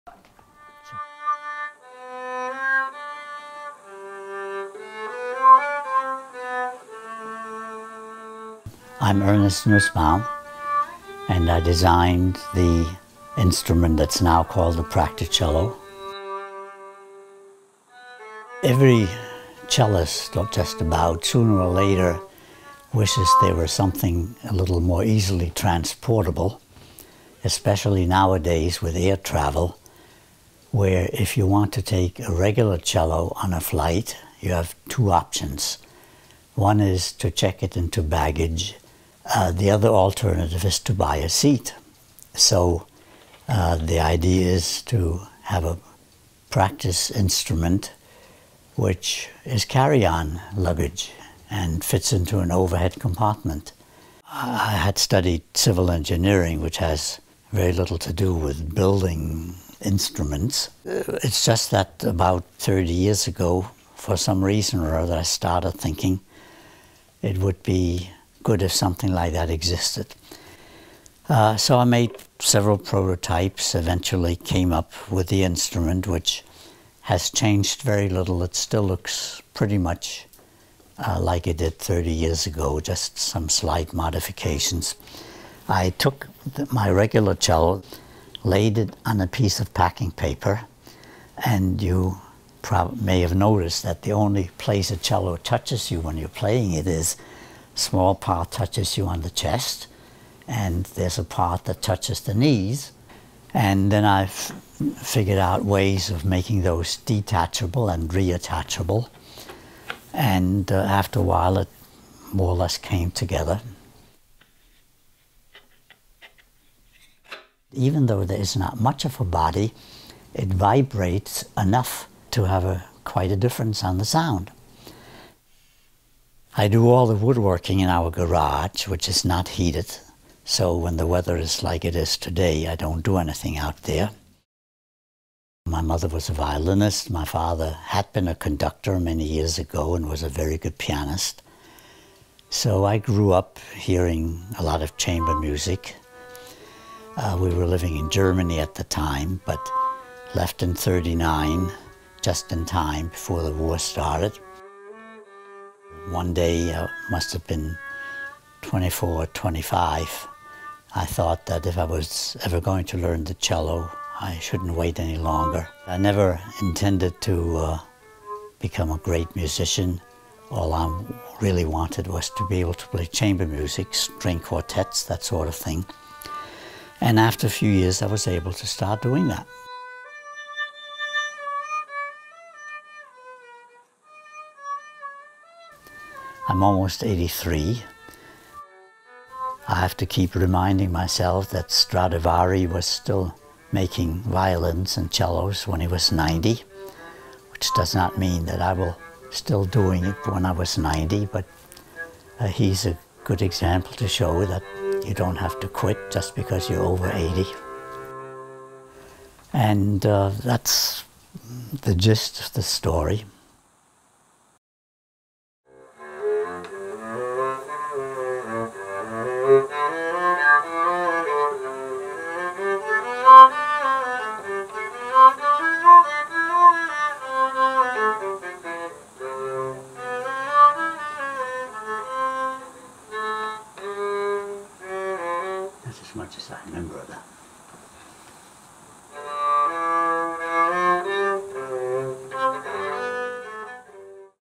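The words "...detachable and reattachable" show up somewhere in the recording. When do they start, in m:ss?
1:46.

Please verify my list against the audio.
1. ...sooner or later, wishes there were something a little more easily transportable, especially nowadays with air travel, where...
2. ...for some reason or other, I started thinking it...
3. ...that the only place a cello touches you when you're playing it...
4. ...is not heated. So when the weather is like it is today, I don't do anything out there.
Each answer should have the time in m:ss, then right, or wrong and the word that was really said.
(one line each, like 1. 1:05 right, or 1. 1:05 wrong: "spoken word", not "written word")
1. 0:21 right
2. 1:03 right
3. 1:33 right
4. 2:09 right.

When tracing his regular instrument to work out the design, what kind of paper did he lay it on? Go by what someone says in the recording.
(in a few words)
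packing paper.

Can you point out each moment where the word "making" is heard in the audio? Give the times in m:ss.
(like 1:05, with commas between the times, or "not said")
1:46, 3:13.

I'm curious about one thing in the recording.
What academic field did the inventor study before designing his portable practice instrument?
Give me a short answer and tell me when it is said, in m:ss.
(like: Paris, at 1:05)
civil engineering, at 0:55.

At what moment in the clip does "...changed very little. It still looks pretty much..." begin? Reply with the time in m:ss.
1:17.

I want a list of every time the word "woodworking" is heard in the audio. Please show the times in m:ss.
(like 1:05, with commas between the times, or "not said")
2:07.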